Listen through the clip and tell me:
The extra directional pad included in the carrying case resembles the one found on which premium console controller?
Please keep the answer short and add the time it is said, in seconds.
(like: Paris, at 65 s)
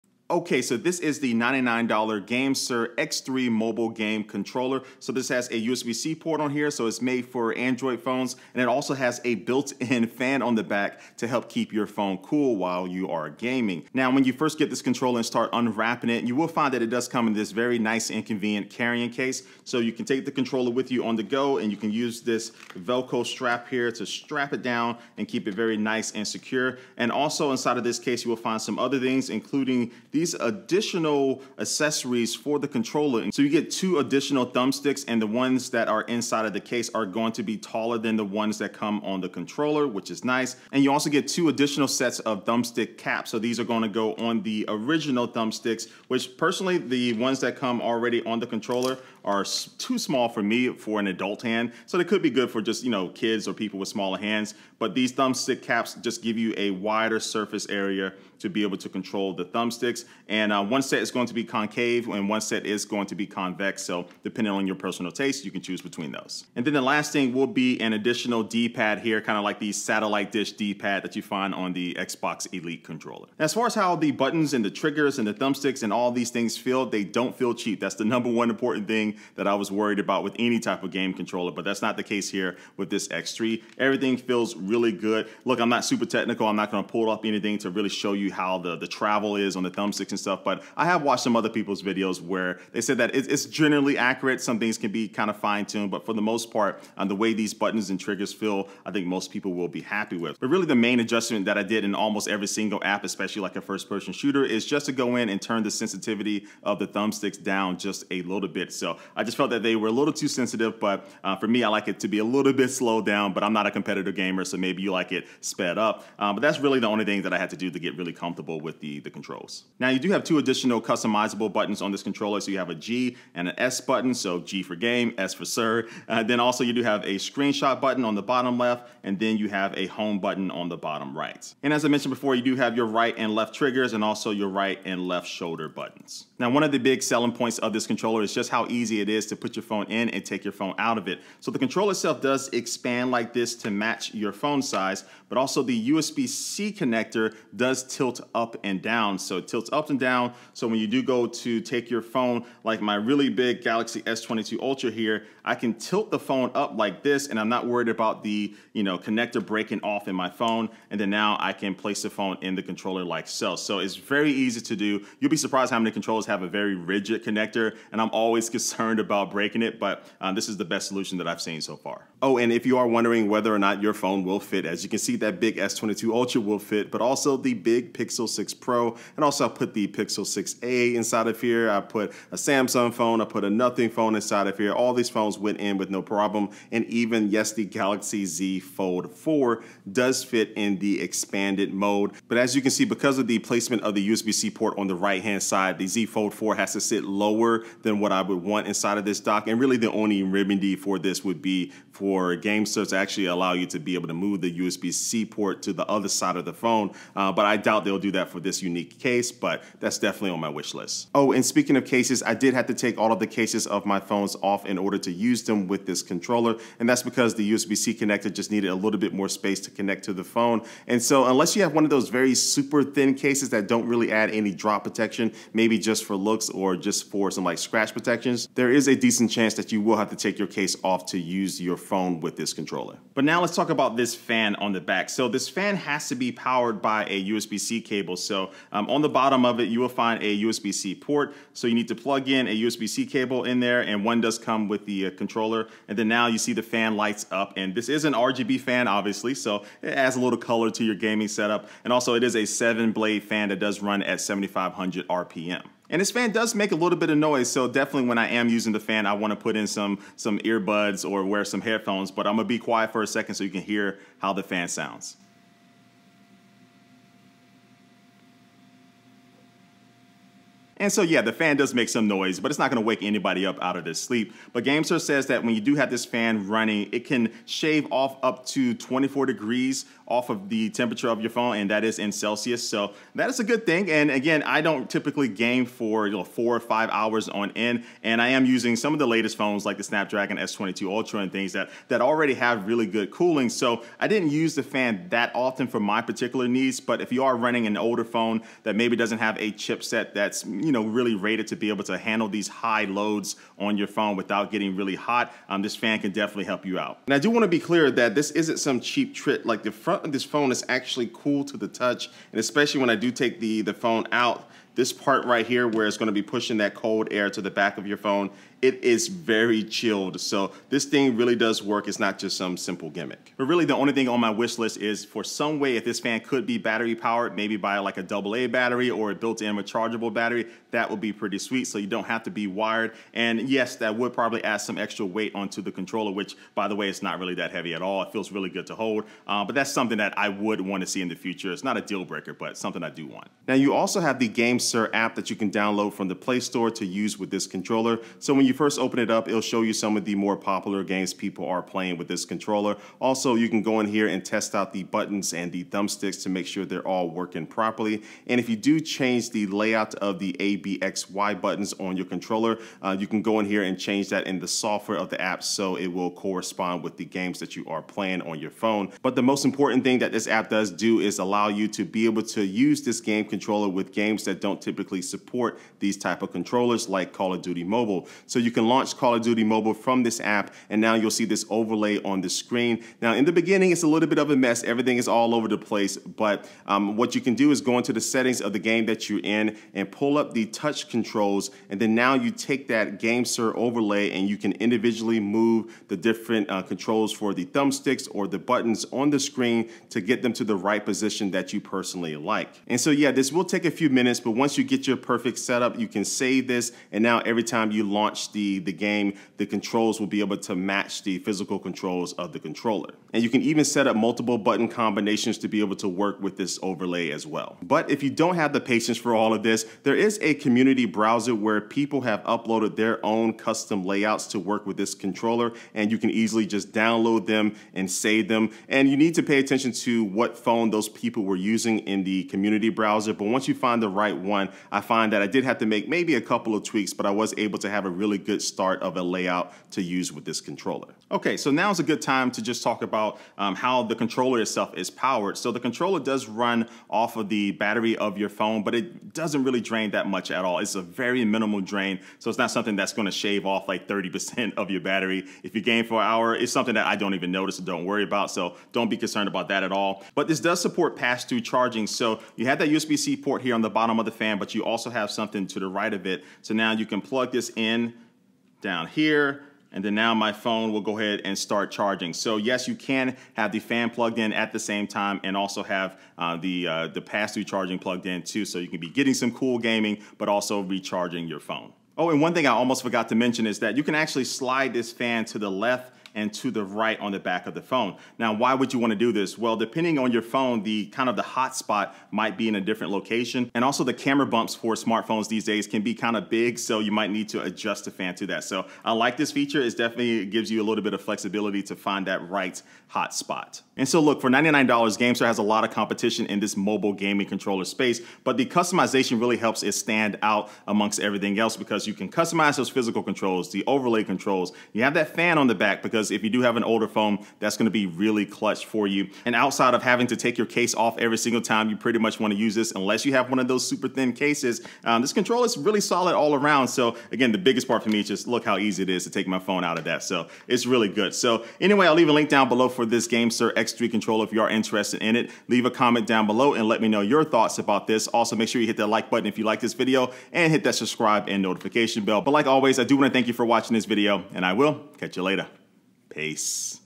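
Xbox Elite controller, at 71 s.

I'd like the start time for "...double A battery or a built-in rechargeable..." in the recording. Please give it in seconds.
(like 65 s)
328 s.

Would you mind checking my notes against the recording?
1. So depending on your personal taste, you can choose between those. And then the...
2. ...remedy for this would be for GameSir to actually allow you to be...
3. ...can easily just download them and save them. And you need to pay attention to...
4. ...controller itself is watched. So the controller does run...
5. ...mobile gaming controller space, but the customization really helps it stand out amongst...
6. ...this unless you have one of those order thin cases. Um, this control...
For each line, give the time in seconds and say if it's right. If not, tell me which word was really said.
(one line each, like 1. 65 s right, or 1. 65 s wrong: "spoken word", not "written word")
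1. 63 s right
2. 200 s right
3. 425 s right
4. 443 s wrong: "powered", not "watched"
5. 506 s right
6. 522 s wrong: "super", not "order".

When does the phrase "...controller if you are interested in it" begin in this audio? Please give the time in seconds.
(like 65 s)
533 s.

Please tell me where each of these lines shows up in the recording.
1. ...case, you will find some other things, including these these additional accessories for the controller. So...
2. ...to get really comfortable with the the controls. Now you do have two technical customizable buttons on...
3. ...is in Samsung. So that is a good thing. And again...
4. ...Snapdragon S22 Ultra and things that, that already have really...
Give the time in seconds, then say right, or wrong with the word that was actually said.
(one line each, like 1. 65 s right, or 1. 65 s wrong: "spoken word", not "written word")
1. 27 s right
2. 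117 s wrong: "additional", not "technical"
3. 281 s wrong: "Celsius", not "Samsung"
4. 289 s right.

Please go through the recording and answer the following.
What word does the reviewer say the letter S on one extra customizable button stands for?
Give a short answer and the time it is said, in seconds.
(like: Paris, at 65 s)
Sir, at 125 s.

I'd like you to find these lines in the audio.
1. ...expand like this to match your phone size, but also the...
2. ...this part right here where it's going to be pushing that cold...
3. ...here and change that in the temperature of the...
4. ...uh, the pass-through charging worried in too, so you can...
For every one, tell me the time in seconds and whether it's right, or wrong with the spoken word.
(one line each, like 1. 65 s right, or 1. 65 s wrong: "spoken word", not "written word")
1. 142 s right
2. 314 s right
3. 363 s wrong: "software", not "temperature"
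4. 476 s wrong: "plugged", not "worried".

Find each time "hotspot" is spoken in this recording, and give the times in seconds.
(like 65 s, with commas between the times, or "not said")
491 s, 502 s.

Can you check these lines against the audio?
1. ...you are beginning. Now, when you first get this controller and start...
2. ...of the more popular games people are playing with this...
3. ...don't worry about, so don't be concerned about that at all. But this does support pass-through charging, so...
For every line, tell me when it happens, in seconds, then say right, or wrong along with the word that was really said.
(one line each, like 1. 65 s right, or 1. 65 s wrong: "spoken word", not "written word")
1. 12 s wrong: "gaming", not "beginning"
2. 349 s right
3. 457 s right.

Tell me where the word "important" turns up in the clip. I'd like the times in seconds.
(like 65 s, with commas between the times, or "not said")
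78 s, 369 s.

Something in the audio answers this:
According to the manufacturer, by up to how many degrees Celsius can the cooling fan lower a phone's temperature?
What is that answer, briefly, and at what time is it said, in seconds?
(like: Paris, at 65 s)
24, at 278 s.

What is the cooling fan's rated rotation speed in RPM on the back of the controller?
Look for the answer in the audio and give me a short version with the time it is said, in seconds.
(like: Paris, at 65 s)
7,500 RPM, at 254 s.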